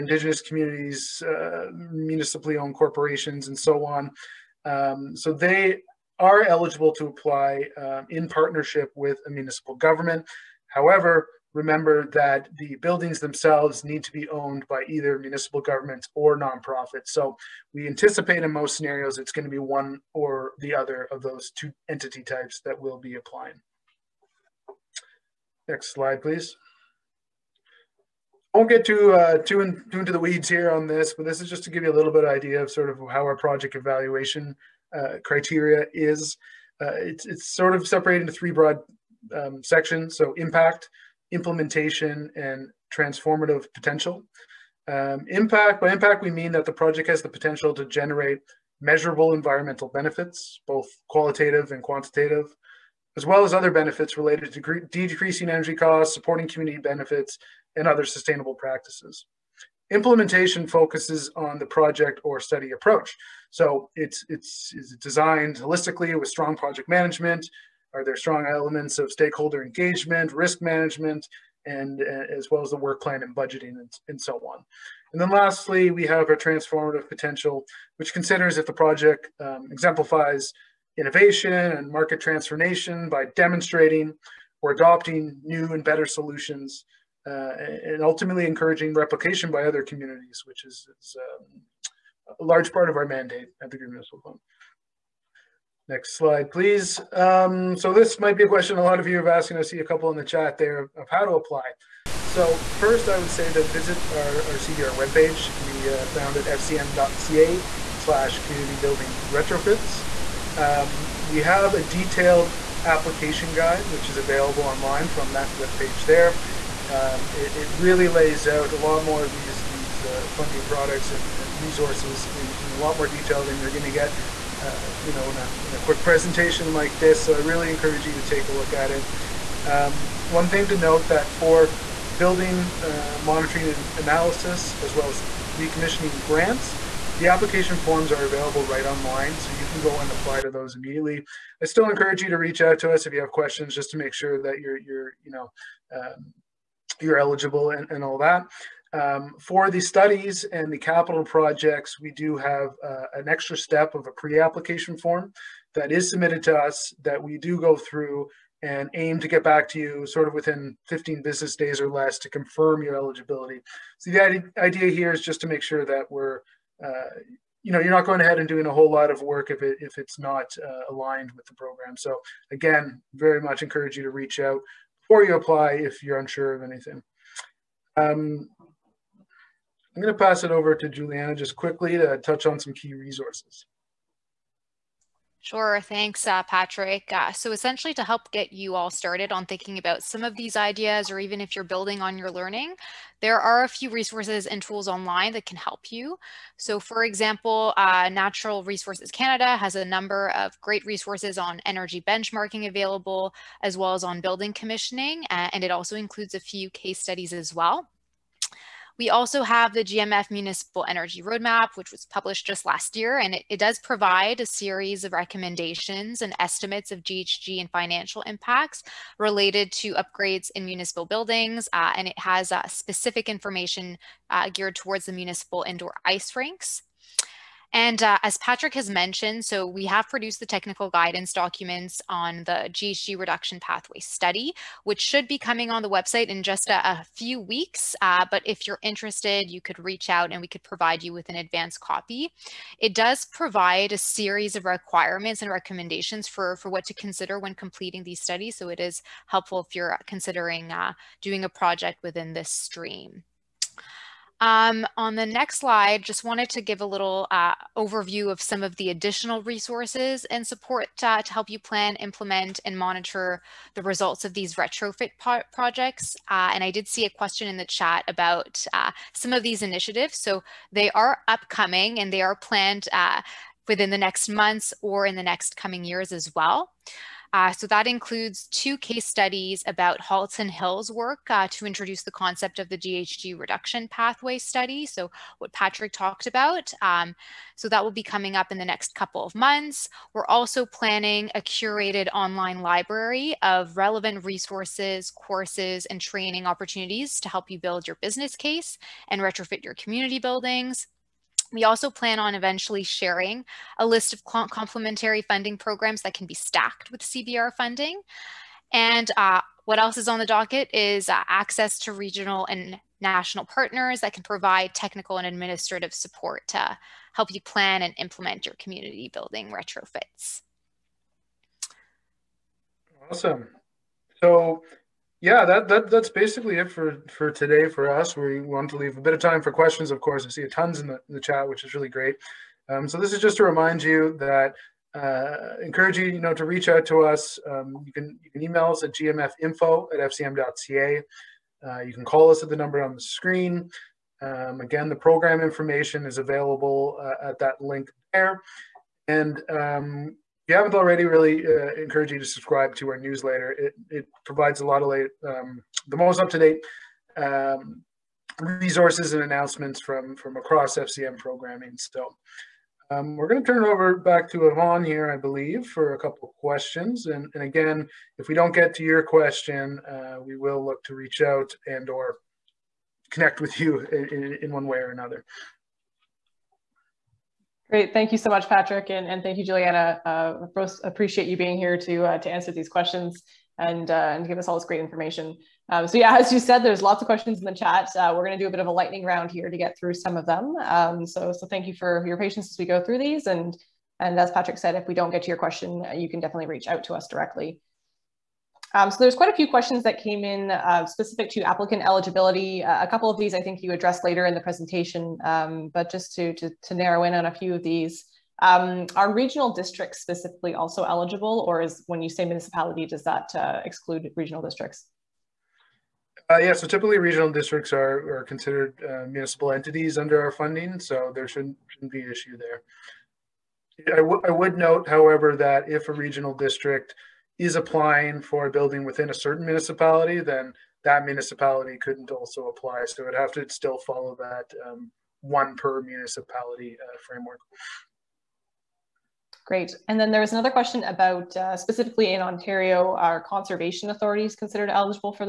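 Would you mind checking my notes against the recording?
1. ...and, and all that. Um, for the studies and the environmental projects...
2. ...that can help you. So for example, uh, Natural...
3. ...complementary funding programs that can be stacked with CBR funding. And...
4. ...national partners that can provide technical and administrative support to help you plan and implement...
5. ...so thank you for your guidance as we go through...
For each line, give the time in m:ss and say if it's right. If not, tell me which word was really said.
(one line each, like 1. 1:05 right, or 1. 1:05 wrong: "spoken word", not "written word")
1. 2:27 wrong: "capital", not "environmental"
2. 3:15 right
3. 5:04 right
4. 5:13 right
5. 6:31 wrong: "patience", not "guidance".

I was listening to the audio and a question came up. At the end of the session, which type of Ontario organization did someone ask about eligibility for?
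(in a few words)
conservation authorities.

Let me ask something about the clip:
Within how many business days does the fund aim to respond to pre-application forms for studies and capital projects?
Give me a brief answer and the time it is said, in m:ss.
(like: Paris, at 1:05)
15, at 2:40.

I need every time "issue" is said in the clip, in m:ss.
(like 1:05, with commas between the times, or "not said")
7:02.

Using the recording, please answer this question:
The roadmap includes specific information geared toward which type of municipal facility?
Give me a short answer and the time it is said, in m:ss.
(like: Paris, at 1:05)
indoor ice rinks, at 3:45.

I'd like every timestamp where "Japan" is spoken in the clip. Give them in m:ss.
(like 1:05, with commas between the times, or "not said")
not said.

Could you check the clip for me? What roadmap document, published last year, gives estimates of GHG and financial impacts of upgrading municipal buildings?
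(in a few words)
GMF Municipal Energy Roadmap.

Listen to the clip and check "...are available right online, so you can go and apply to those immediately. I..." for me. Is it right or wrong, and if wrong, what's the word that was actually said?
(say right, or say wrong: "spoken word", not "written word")
right.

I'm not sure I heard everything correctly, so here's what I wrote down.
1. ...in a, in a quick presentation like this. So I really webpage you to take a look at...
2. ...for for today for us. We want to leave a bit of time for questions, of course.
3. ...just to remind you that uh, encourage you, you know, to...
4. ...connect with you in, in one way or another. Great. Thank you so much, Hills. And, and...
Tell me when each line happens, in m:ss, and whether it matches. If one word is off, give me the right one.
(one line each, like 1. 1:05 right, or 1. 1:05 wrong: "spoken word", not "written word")
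1. 2:05 wrong: "encourage", not "webpage"
2. 5:26 right
3. 5:33 right
4. 6:13 wrong: "Patrick", not "Hills".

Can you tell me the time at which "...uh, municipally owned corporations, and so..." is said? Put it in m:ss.
0:01.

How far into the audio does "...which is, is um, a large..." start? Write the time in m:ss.
1:30.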